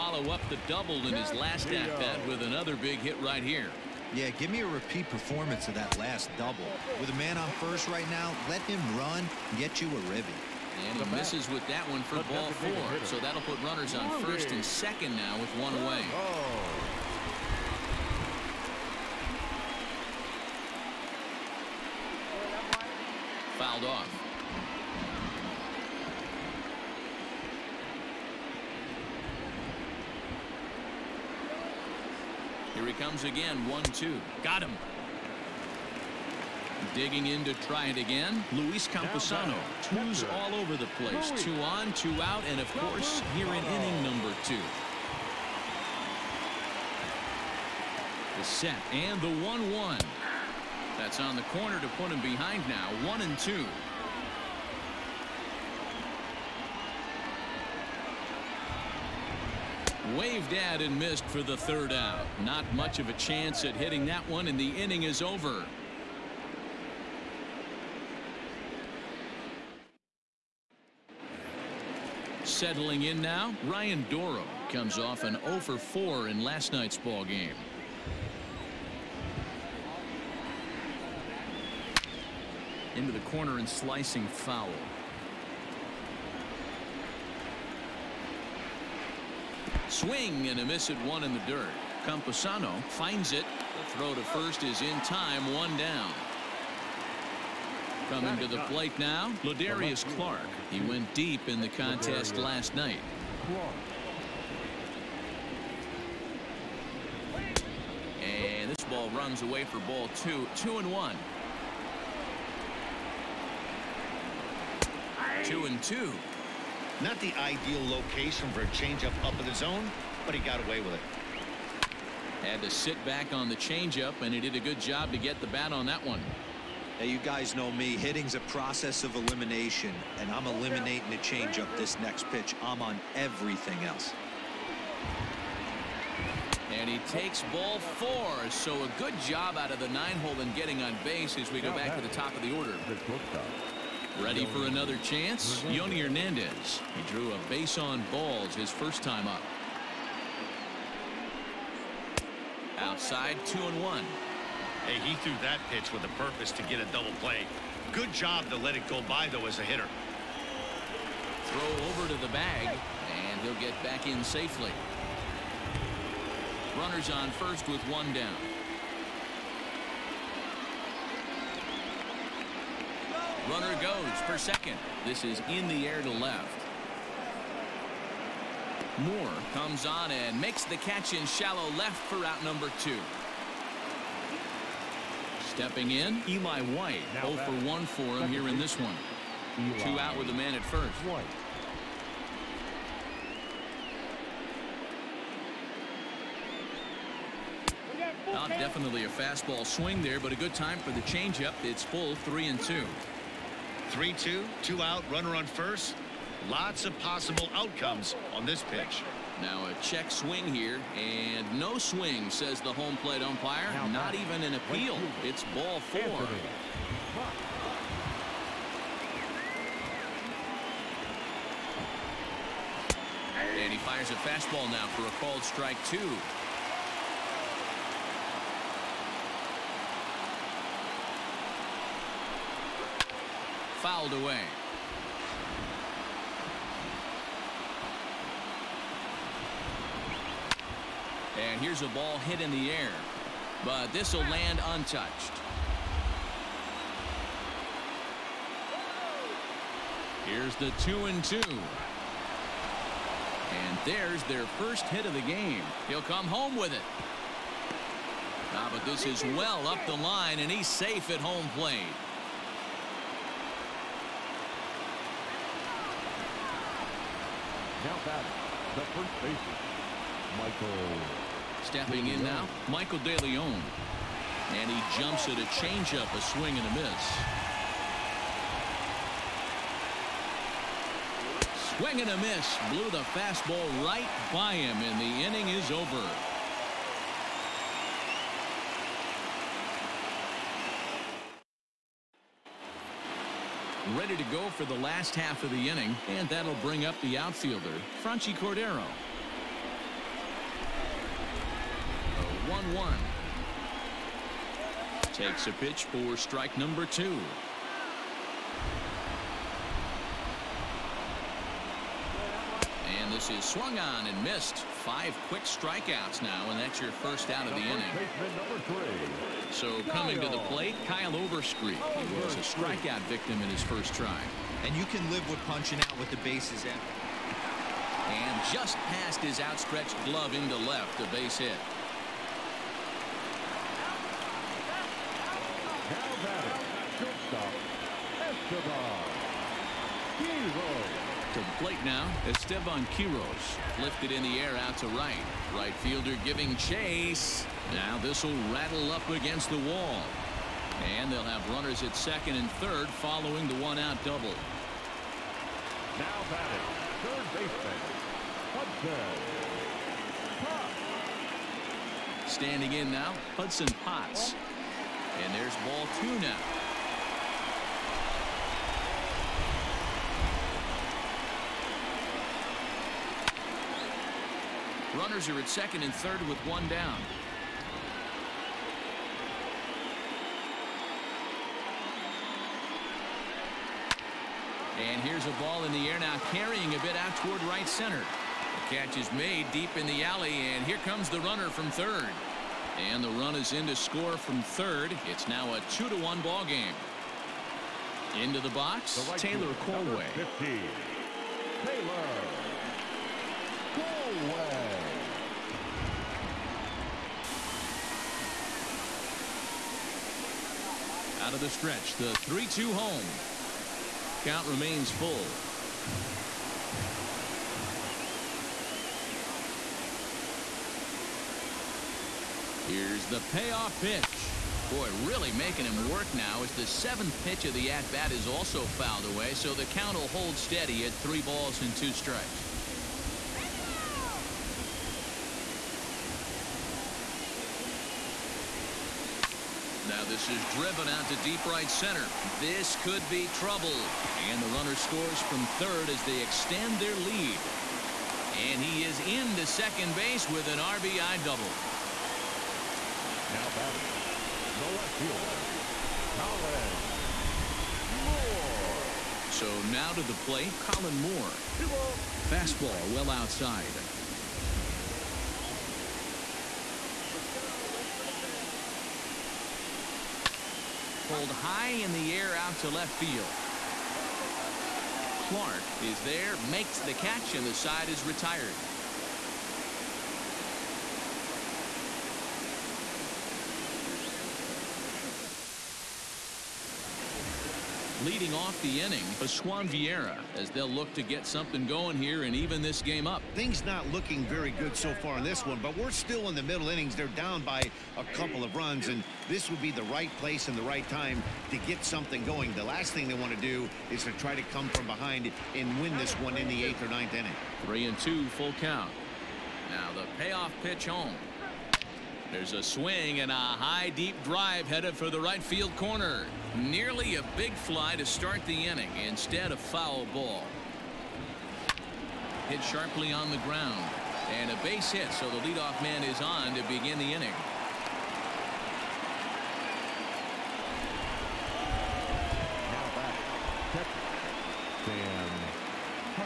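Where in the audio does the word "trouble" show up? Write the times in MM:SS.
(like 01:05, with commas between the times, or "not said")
07:23.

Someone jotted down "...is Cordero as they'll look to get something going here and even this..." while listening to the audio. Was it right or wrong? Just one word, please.
wrong.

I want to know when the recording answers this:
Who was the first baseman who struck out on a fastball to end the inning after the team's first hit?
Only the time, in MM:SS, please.
04:32.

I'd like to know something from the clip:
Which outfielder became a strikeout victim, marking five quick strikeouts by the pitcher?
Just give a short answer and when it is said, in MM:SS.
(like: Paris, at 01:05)
Franchy Cordero, at 04:58.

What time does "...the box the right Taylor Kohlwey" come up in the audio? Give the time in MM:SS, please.
06:38.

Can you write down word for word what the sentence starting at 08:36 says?
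Nearly a big fly to start the inning instead of foul ball.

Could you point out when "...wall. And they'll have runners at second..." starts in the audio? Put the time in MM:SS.
05:49.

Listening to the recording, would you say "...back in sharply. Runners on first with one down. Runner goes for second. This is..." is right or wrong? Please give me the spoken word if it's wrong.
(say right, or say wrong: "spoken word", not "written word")
wrong: "safely", not "sharply".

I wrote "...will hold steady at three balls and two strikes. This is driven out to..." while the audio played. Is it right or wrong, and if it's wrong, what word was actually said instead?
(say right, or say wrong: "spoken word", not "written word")
right.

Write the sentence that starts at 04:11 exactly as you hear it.
And there's their first hit of the game.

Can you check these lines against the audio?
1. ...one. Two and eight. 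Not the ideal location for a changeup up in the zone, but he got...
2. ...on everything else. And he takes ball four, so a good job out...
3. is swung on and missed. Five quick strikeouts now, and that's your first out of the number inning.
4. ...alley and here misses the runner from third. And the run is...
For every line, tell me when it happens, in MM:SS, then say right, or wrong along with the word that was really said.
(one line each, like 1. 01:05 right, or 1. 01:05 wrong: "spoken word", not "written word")
1. 01:50 wrong: "two", not "eight"
2. 02:12 right
3. 05:13 right
4. 06:30 wrong: "comes", not "misses".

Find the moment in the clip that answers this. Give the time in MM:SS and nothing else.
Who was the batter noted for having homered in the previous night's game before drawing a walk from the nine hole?
01:39.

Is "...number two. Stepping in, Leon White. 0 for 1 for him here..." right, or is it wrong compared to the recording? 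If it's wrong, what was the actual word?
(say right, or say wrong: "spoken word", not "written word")
wrong: "Eli", not "Leon".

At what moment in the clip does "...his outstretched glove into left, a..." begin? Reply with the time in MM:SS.
05:29.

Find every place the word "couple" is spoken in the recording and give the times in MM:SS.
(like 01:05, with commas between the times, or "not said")
08:18.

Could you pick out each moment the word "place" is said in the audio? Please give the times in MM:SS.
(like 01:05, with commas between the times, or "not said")
00:40, 08:20.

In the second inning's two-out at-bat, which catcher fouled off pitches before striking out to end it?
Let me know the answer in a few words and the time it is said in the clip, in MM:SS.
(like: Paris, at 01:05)
Luis Campusano, at 00:38.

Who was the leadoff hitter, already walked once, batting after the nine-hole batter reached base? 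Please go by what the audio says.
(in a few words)
Yonny Hernandez.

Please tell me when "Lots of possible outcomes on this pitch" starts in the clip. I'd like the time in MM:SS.
03:26.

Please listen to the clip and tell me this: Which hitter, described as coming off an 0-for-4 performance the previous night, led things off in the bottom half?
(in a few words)
Ryan Dorow.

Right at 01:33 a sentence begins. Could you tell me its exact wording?
The throw to first is in time, one down.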